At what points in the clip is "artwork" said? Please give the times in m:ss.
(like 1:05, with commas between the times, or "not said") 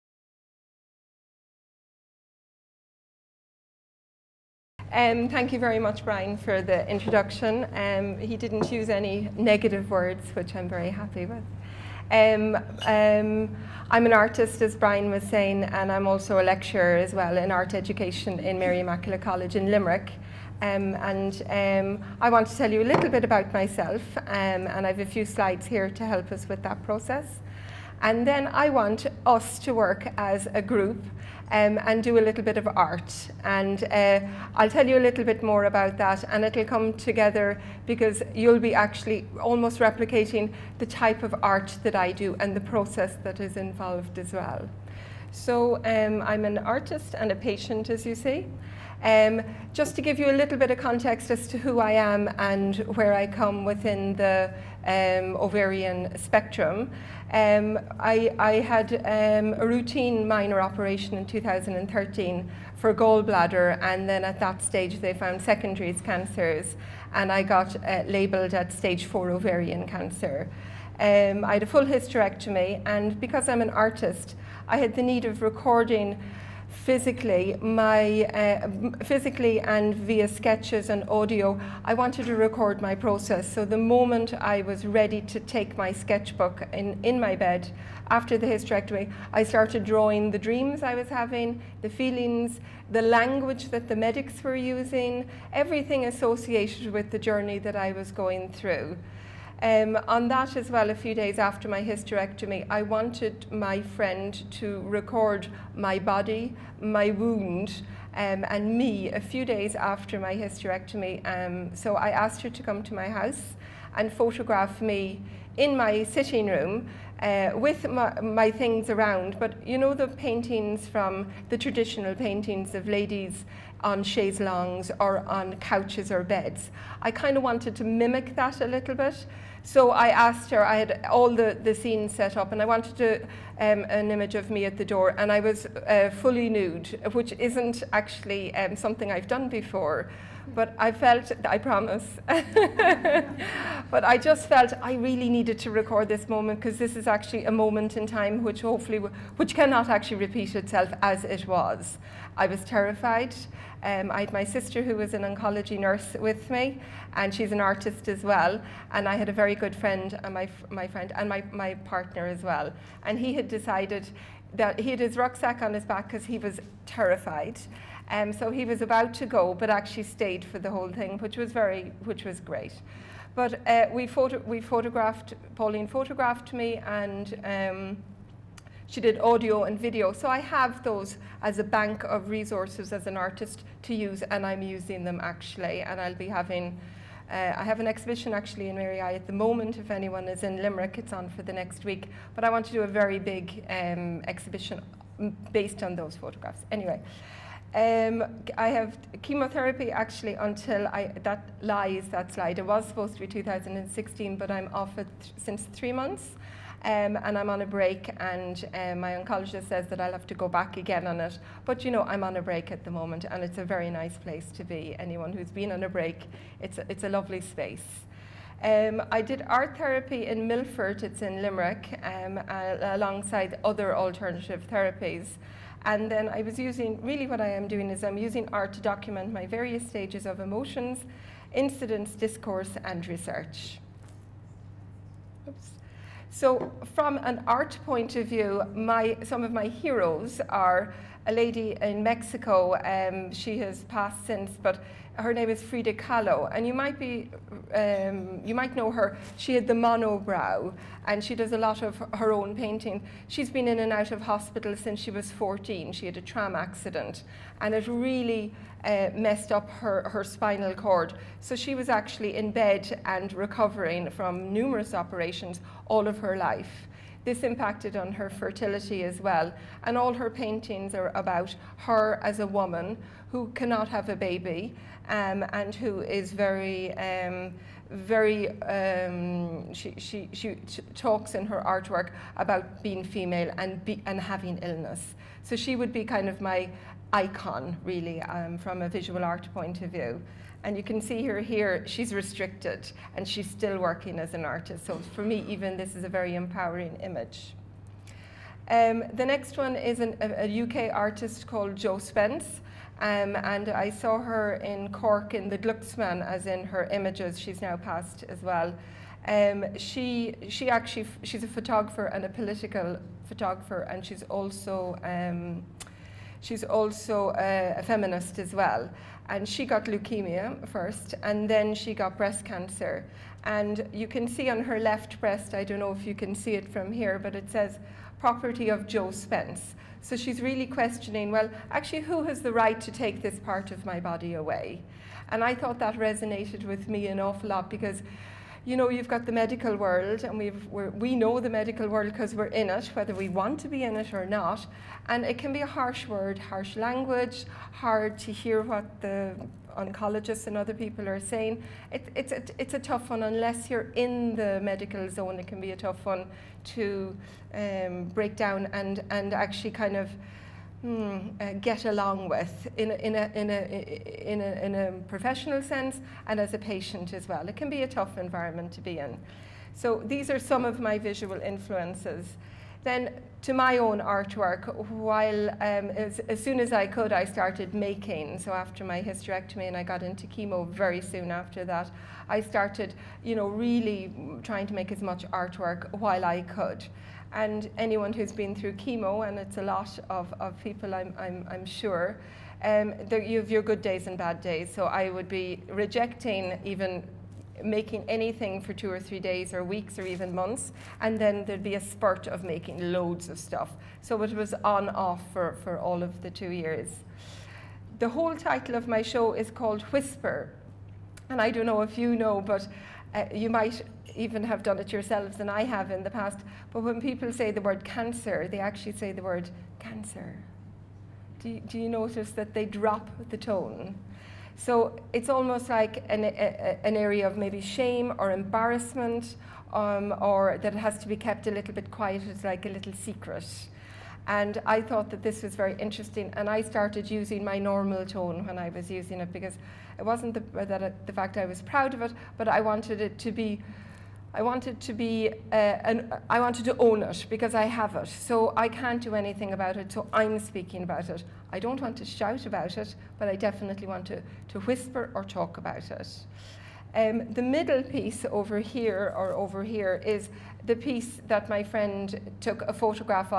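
4:41, 6:13, 6:25.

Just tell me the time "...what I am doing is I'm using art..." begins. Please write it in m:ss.
3:47.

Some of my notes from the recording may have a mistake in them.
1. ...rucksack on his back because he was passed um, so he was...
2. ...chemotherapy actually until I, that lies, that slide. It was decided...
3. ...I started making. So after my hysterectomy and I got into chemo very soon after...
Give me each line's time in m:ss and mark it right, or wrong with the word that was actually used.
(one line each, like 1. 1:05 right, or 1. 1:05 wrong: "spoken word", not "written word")
1. 2:45 wrong: "terrified", not "passed"
2. 3:19 wrong: "supposed", not "decided"
3. 6:17 right.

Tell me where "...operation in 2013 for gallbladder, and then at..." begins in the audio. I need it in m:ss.
1:00.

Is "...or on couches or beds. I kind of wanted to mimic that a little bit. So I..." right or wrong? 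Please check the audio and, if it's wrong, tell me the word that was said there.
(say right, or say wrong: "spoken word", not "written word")
right.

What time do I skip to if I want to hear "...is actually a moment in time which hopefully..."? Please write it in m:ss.
2:26.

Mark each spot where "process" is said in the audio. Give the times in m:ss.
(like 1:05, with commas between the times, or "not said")
0:26, 0:42, 1:22.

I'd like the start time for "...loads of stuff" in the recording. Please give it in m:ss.
6:42.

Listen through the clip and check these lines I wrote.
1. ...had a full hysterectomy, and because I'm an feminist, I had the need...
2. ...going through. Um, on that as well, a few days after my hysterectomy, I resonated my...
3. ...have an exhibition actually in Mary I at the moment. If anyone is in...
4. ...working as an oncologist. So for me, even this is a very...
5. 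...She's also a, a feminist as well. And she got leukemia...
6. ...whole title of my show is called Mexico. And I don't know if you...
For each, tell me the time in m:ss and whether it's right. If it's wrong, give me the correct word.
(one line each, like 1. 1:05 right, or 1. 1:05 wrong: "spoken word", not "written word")
1. 1:11 wrong: "artist", not "feminist"
2. 1:38 wrong: "wanted", not "resonated"
3. 3:07 right
4. 4:53 wrong: "artist", not "oncologist"
5. 5:16 right
6. 6:48 wrong: "Whisper", not "Mexico".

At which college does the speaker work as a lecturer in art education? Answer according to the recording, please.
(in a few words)
Mary Immaculate College.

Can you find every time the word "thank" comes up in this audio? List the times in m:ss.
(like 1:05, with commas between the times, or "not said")
0:05.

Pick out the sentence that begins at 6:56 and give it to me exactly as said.
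But when people say the word cancer, they actually say the word cancer.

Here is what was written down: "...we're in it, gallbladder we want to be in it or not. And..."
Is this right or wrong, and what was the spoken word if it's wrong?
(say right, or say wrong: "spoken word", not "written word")
wrong: "whether", not "gallbladder".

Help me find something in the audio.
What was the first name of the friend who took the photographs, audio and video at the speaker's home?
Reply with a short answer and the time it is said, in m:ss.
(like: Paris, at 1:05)
Pauline, at 2:55.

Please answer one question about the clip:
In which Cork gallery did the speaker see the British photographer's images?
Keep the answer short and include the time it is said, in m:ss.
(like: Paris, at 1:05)
Glucksman, at 5:05.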